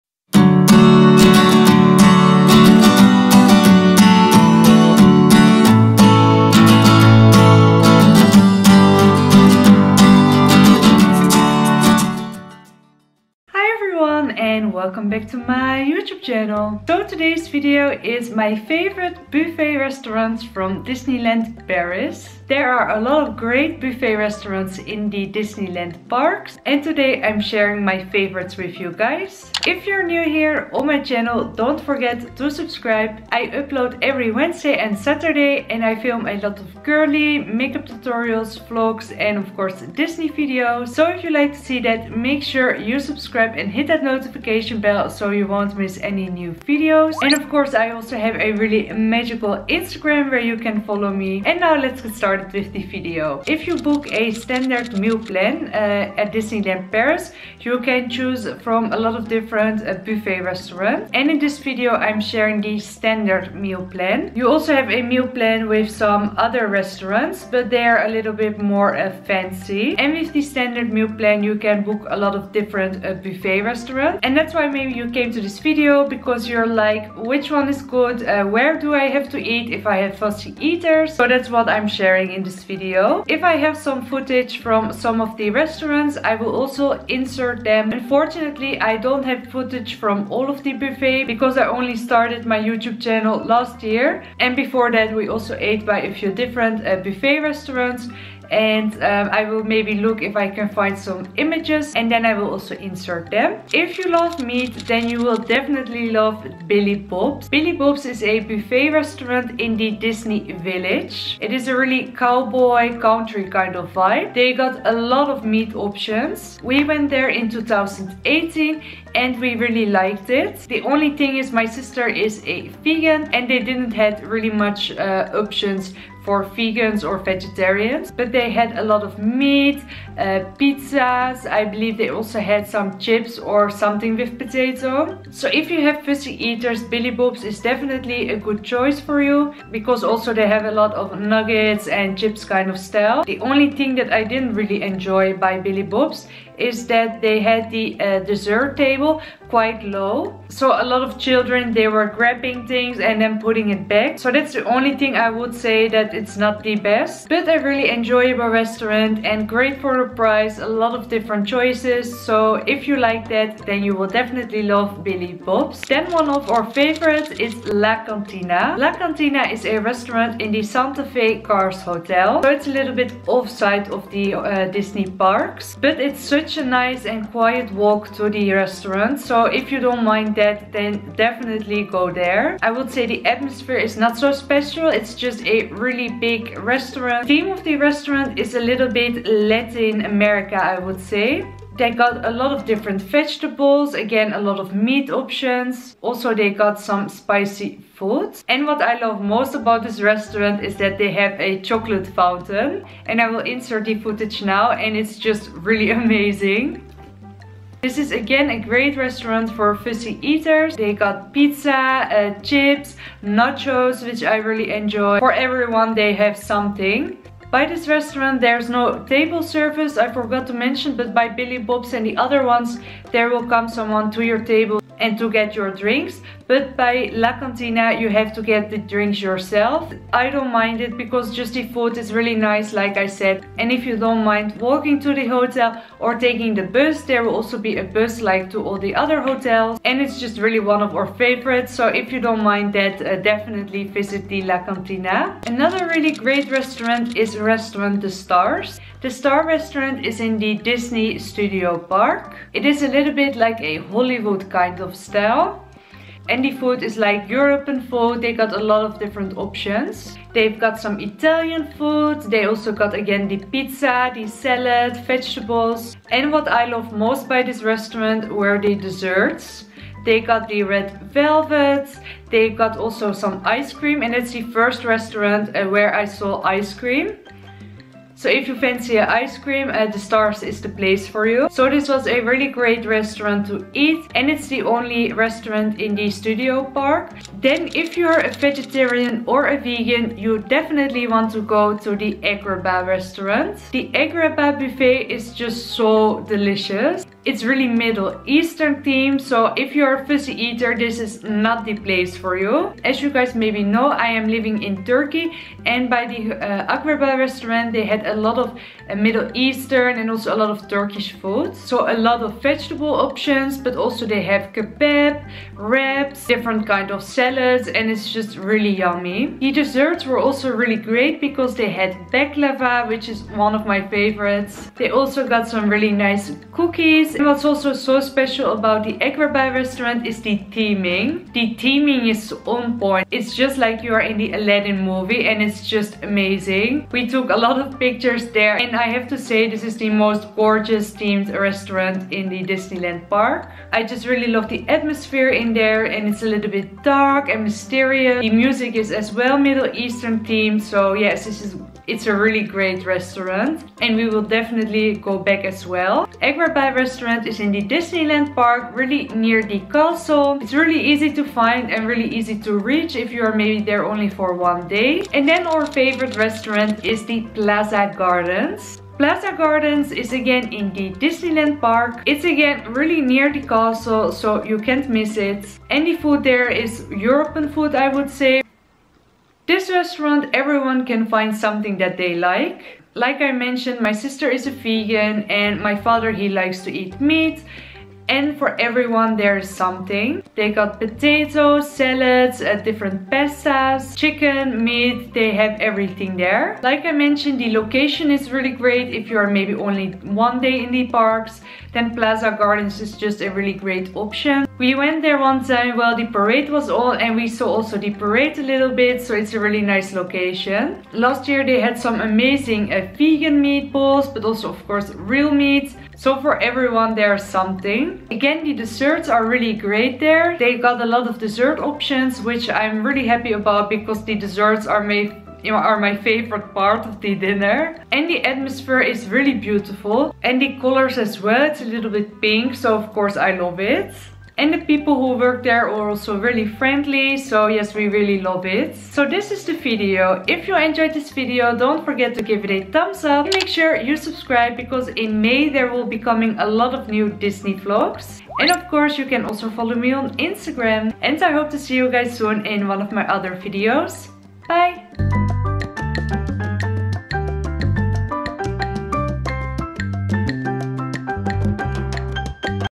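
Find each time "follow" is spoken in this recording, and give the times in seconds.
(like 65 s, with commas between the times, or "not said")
50 s, 449 s.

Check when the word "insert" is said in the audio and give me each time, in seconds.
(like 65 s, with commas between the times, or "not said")
87 s, 102 s, 203 s.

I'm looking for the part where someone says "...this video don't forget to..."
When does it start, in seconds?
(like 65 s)
440 s.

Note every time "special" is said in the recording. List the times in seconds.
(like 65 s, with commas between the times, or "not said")
184 s, 328 s.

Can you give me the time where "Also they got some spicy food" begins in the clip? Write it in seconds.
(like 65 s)
196 s.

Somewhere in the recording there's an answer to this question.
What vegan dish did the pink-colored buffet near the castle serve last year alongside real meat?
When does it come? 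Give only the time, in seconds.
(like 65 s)
412 s.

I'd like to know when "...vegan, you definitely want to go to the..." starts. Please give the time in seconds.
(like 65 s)
289 s.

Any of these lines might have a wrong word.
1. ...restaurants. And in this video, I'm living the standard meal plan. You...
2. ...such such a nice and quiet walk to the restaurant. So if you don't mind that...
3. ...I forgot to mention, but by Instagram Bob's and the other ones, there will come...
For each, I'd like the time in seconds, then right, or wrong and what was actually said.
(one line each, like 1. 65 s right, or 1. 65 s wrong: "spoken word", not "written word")
1. 60 s wrong: "sharing", not "living"
2. 176 s right
3. 219 s wrong: "Billy", not "Instagram".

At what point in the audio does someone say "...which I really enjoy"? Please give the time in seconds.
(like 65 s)
214 s.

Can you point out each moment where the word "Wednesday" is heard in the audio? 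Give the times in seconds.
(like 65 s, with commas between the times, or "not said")
34 s.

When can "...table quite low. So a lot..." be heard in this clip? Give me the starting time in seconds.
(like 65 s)
148 s.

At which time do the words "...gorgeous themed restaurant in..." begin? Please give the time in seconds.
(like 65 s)
340 s.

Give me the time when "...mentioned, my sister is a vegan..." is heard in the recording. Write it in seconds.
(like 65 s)
383 s.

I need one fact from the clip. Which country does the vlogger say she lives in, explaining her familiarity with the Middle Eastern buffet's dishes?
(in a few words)
Turkey.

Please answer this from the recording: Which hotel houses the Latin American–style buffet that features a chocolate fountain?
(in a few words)
Santa Fe Cars Hotel.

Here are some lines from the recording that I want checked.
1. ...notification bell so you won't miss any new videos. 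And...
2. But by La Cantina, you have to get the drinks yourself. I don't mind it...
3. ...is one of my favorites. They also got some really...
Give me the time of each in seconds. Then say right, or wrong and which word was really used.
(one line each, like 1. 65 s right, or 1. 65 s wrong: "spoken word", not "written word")
1. 44 s right
2. 226 s right
3. 323 s right.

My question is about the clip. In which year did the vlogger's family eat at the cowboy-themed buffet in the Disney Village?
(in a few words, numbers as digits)
2018.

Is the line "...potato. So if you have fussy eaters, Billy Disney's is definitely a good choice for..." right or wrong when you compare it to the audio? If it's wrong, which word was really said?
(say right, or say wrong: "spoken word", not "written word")
wrong: "Bob", not "Disney".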